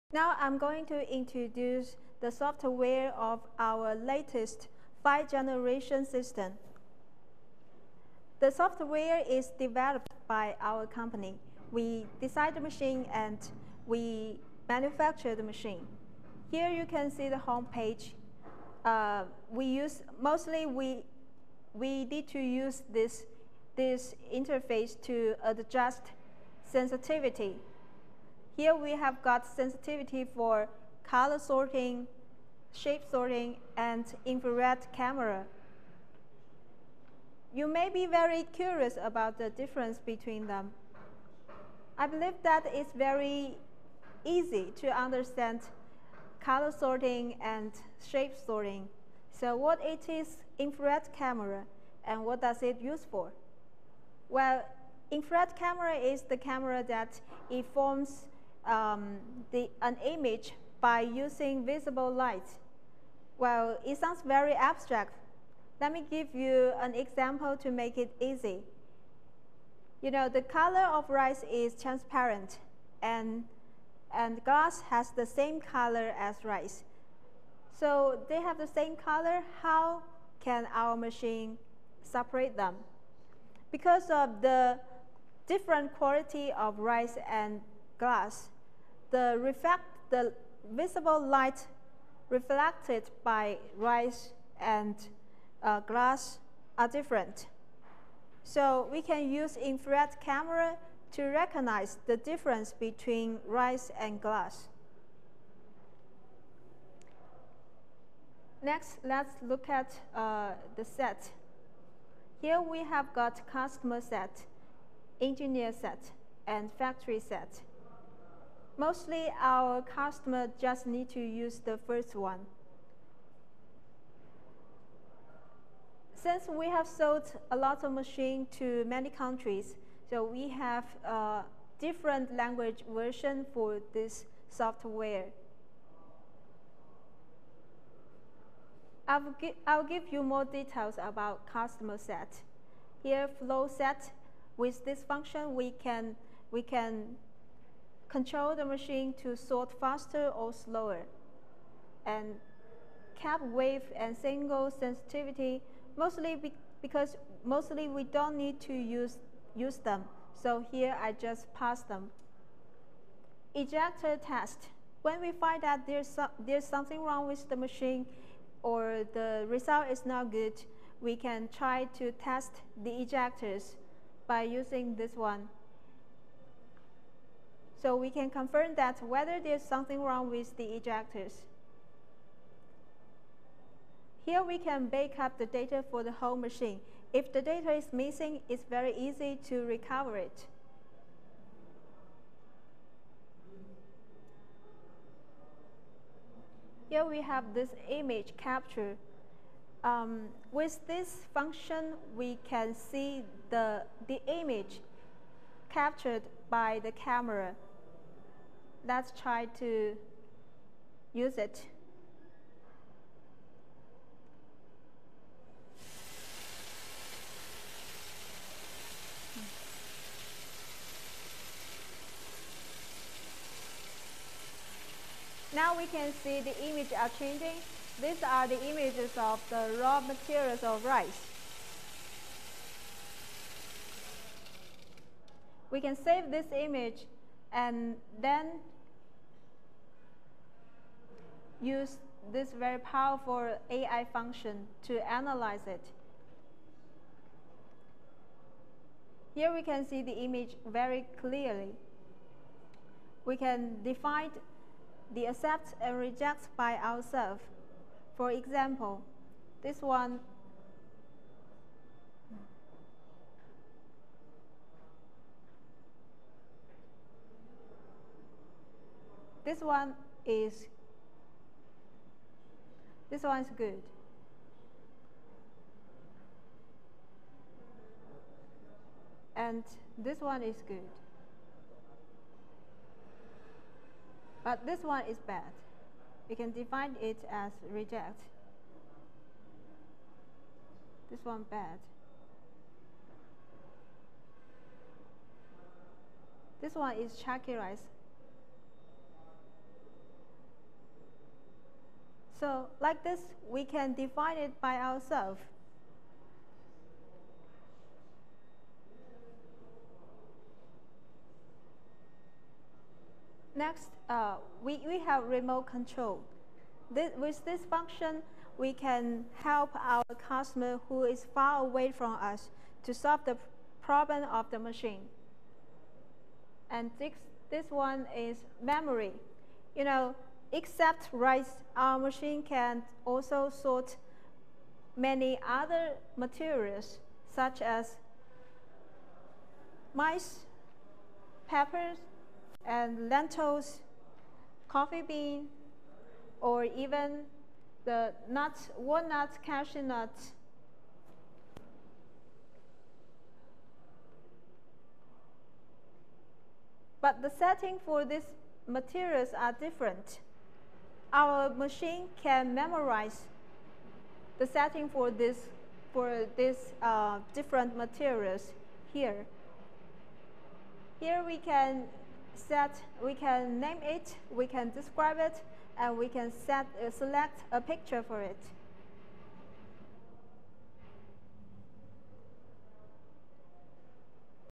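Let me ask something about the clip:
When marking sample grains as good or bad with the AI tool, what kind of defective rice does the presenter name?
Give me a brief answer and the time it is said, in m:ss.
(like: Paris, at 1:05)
Chalky rice, at 4:57.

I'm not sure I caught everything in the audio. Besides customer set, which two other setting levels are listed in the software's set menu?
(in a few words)
Engineer set and factory set.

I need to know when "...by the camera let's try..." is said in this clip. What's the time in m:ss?
3:26.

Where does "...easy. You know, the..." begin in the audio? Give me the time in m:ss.
1:08.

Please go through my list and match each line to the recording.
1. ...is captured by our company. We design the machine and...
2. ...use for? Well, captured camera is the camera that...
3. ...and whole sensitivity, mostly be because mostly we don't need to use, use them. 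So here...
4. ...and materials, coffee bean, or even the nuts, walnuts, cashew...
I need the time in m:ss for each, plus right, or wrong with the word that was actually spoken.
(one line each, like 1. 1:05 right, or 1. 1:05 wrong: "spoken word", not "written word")
1. 0:09 wrong: "developed", not "captured"
2. 0:52 wrong: "infrared", not "captured"
3. 2:33 wrong: "single", not "whole"
4. 5:42 wrong: "lentils", not "materials".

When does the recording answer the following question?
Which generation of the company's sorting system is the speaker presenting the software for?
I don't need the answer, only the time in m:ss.
0:05.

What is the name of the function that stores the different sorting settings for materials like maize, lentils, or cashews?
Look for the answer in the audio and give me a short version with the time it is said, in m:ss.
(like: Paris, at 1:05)
Memory, at 5:28.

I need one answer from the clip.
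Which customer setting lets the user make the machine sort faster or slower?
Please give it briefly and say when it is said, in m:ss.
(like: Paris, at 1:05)
Flow set, at 2:23.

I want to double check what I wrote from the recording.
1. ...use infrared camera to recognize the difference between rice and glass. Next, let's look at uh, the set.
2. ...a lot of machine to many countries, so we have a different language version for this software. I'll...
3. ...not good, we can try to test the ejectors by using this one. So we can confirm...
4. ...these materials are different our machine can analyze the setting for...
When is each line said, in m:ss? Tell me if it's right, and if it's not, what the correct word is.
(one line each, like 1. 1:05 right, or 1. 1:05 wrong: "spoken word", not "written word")
1. 1:39 right
2. 2:07 right
3. 2:50 right
4. 5:58 wrong: "memorize", not "analyze".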